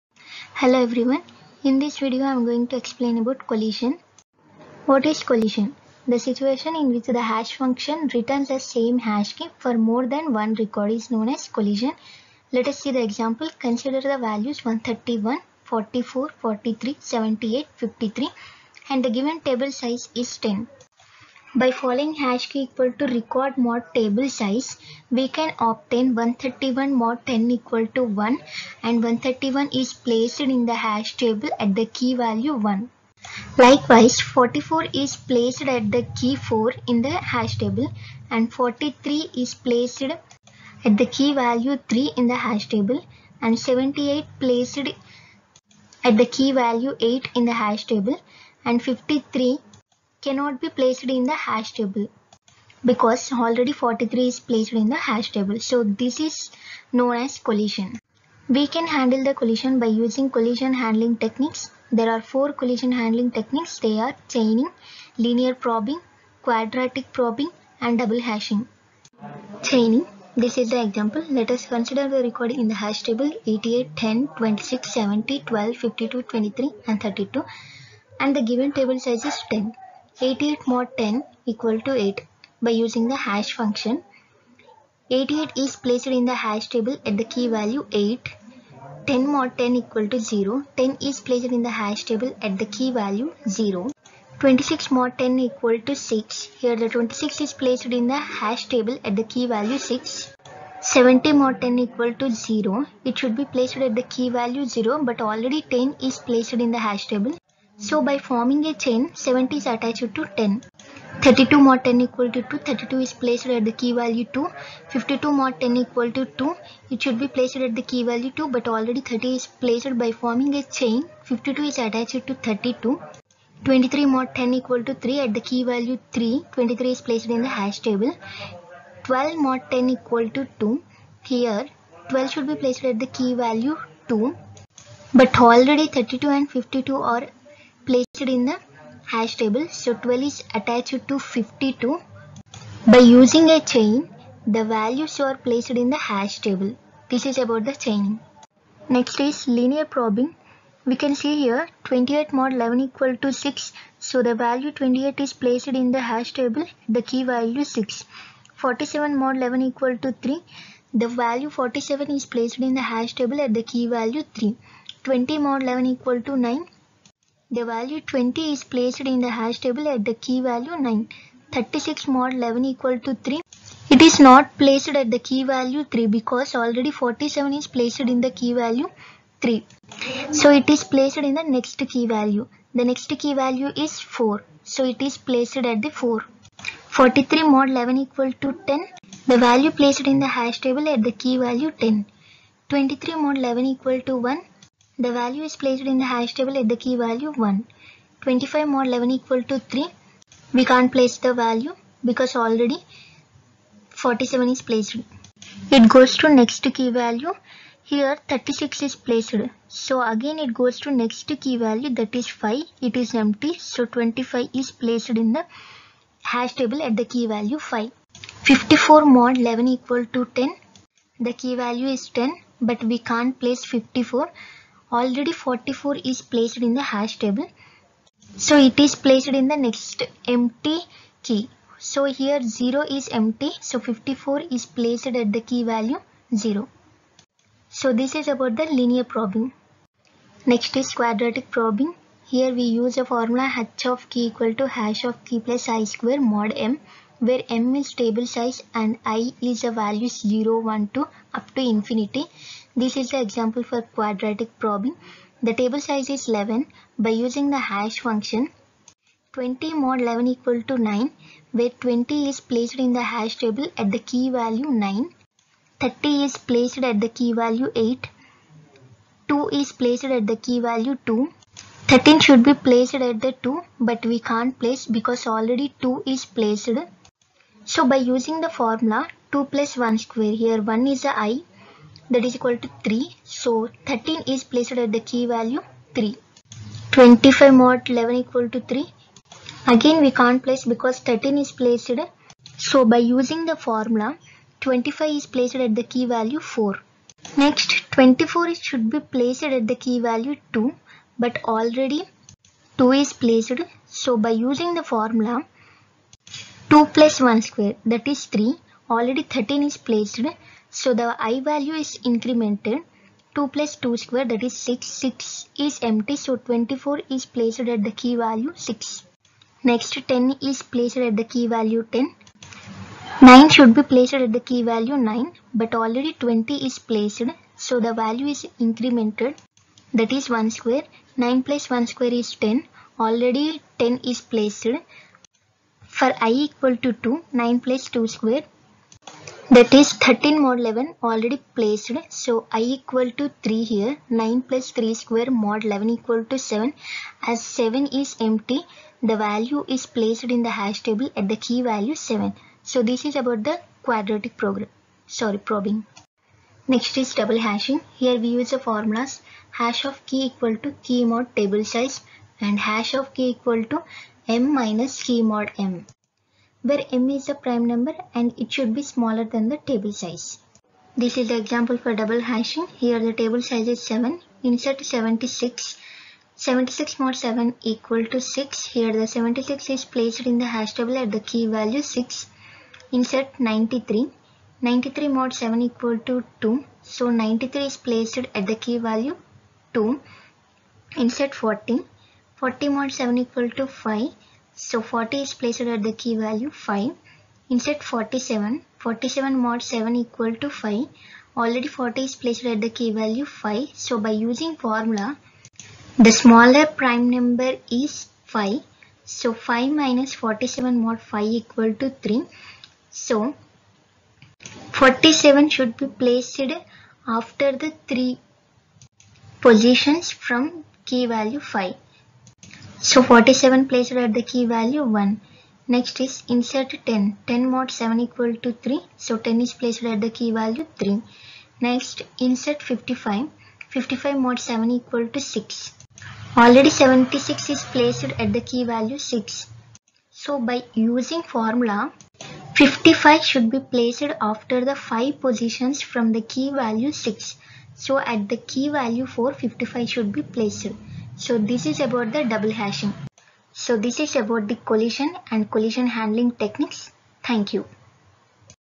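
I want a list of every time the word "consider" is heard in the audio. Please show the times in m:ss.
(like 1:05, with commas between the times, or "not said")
0:13, 1:11.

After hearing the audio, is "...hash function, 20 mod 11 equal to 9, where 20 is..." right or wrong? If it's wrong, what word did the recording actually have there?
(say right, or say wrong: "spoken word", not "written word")
right.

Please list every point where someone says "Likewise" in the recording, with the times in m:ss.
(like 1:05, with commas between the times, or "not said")
0:33.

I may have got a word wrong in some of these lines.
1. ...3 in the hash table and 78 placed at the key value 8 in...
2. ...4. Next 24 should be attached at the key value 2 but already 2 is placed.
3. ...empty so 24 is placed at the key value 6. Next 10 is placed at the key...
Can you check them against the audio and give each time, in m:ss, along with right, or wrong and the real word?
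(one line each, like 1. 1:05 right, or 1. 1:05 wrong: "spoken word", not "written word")
1. 0:41 right
2. 4:56 wrong: "placed", not "attached"
3. 5:15 right.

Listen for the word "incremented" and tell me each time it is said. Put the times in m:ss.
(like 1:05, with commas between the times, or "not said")
5:12, 5:28.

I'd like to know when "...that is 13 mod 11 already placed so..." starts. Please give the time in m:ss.
5:39.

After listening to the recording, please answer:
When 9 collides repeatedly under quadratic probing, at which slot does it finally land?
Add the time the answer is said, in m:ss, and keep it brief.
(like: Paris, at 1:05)
7, at 5:51.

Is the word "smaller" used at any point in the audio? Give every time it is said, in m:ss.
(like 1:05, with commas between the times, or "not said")
6:08, 6:46.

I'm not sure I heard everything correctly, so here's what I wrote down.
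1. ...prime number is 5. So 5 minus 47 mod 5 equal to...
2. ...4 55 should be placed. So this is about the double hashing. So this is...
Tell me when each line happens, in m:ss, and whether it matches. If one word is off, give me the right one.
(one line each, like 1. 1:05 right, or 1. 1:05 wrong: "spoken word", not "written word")
1. 6:46 right
2. 7:29 right.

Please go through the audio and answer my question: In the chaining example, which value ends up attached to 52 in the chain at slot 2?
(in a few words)
12.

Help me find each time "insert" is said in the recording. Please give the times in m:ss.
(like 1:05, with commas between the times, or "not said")
6:14, 6:22, 6:30, 6:37, 7:06, 7:12.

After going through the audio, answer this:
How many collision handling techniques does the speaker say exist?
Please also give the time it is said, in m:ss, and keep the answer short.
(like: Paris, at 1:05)
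4, at 1:02.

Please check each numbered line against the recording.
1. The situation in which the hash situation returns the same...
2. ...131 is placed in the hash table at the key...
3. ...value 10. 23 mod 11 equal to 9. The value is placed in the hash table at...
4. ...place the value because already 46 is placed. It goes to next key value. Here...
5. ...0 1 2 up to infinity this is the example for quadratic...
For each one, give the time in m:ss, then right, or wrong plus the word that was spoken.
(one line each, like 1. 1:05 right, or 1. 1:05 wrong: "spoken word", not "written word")
1. 0:06 wrong: "function", not "situation"
2. 0:29 right
3. 3:11 wrong: "1", not "9"
4. 3:20 wrong: "47", not "46"
5. 4:10 right.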